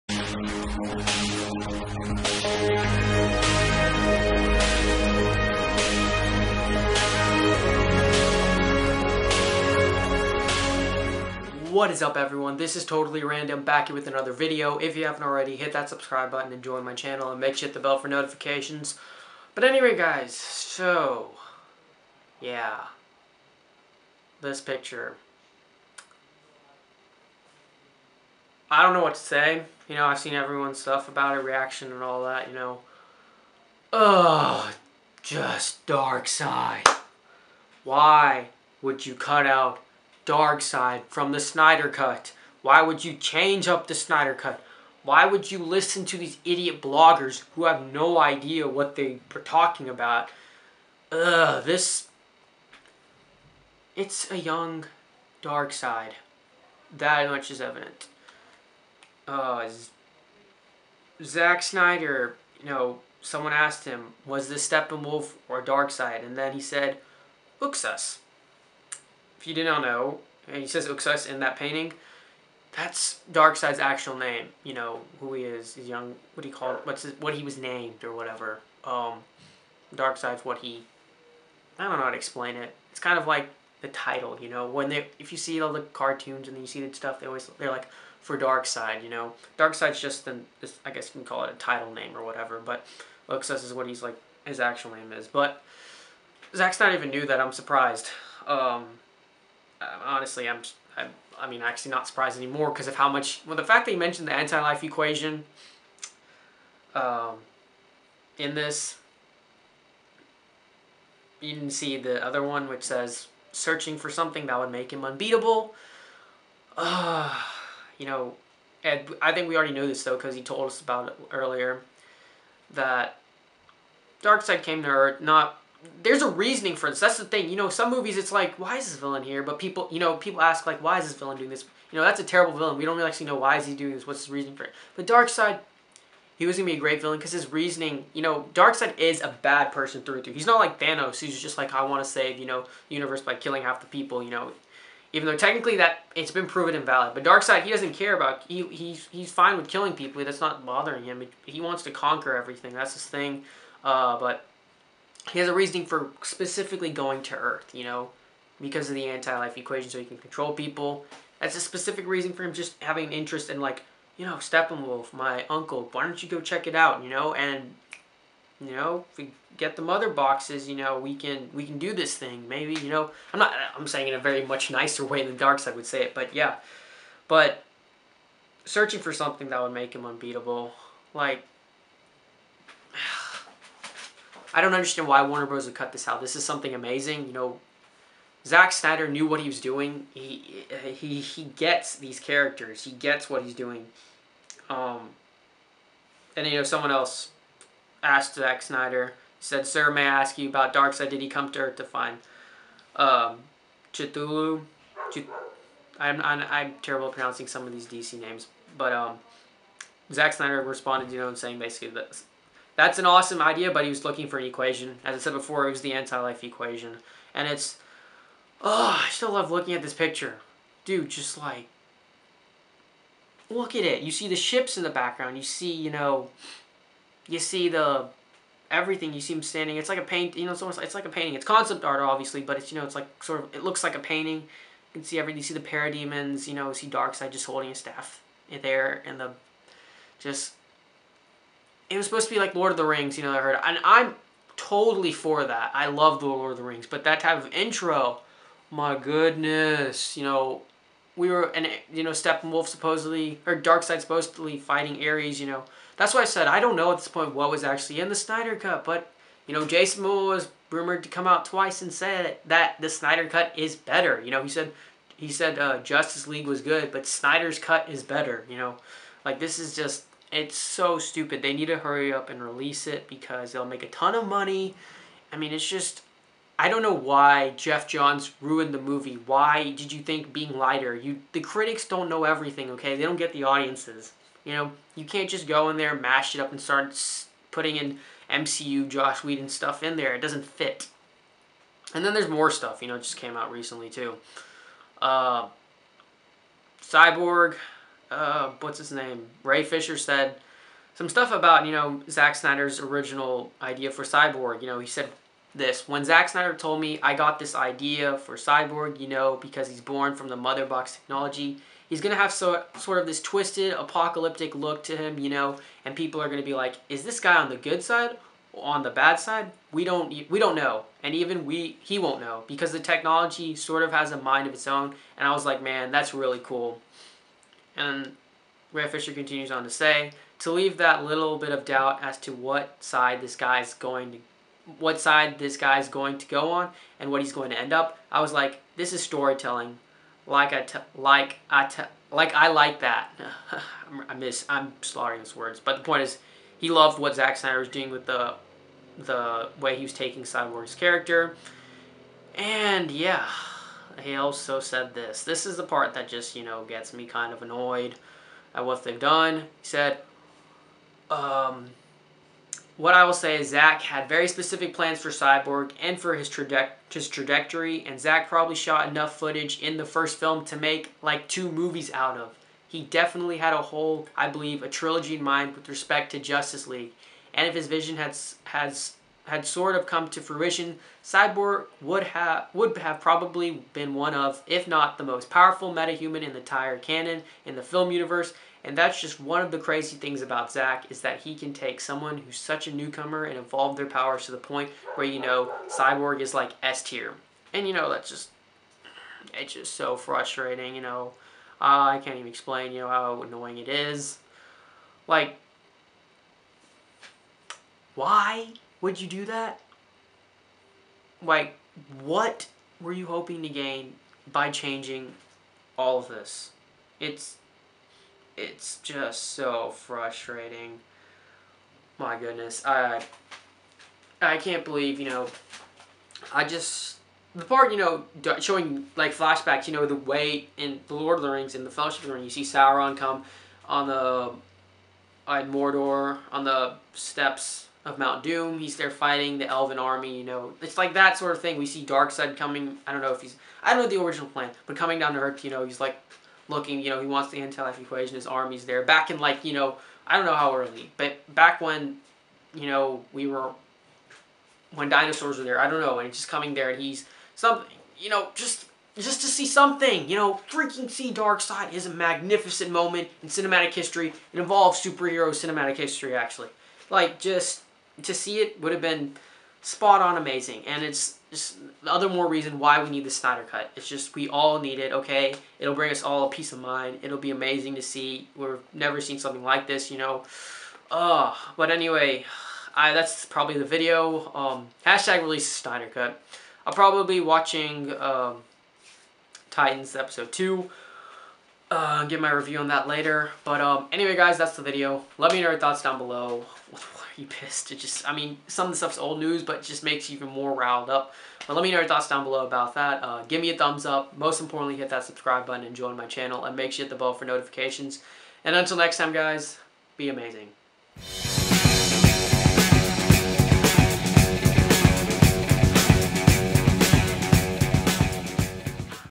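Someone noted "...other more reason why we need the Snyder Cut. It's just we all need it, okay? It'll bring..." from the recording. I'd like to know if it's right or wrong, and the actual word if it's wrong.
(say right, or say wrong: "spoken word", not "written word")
right.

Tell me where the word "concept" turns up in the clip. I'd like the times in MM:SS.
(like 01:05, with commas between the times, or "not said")
03:51.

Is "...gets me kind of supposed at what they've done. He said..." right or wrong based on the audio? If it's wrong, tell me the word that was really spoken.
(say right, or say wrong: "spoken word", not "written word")
wrong: "annoyed", not "supposed".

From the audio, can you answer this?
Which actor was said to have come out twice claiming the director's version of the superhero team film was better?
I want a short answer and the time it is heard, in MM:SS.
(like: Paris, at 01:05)
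Jason Momoa, at 04:19.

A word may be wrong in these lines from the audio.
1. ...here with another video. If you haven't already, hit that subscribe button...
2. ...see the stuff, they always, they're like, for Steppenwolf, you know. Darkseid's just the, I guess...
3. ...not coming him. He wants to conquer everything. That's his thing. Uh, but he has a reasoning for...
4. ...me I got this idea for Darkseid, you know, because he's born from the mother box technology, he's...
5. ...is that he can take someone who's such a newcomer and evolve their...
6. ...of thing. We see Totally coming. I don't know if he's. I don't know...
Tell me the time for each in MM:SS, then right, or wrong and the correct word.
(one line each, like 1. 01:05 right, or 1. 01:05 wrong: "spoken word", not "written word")
1. 00:13 right
2. 01:26 wrong: "Darkseid", not "Steppenwolf"
3. 02:30 wrong: "bothering", not "coming"
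4. 05:06 wrong: "Cyborg", not "Darkseid"
5. 06:30 right
6. 07:21 wrong: "Darkseid", not "Totally".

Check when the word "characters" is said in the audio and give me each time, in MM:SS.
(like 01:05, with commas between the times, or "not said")
03:12, 05:50.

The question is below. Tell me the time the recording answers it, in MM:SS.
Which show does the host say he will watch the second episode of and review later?
08:09.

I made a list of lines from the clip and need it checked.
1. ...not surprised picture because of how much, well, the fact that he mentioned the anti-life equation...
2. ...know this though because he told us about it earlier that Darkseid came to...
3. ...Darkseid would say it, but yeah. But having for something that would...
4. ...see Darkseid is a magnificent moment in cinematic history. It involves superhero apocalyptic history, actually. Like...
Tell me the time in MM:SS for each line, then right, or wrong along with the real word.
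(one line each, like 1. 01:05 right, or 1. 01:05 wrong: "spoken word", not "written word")
1. 01:41 wrong: "anymore", not "picture"
2. 01:59 right
3. 02:55 wrong: "searching", not "having"
4. 07:40 wrong: "cinematic", not "apocalyptic".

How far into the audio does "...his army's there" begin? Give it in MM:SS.
07:28.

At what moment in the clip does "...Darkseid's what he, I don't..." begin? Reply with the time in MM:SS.
01:19.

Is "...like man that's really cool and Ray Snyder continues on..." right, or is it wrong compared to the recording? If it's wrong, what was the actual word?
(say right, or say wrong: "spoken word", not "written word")
wrong: "Fisher", not "Snyder".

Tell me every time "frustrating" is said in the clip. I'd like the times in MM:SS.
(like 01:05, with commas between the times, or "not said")
06:39, 06:59.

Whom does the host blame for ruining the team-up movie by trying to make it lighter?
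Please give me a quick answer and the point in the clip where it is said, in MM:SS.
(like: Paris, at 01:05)
Geoff Johns, at 04:37.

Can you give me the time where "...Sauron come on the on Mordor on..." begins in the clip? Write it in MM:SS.
07:12.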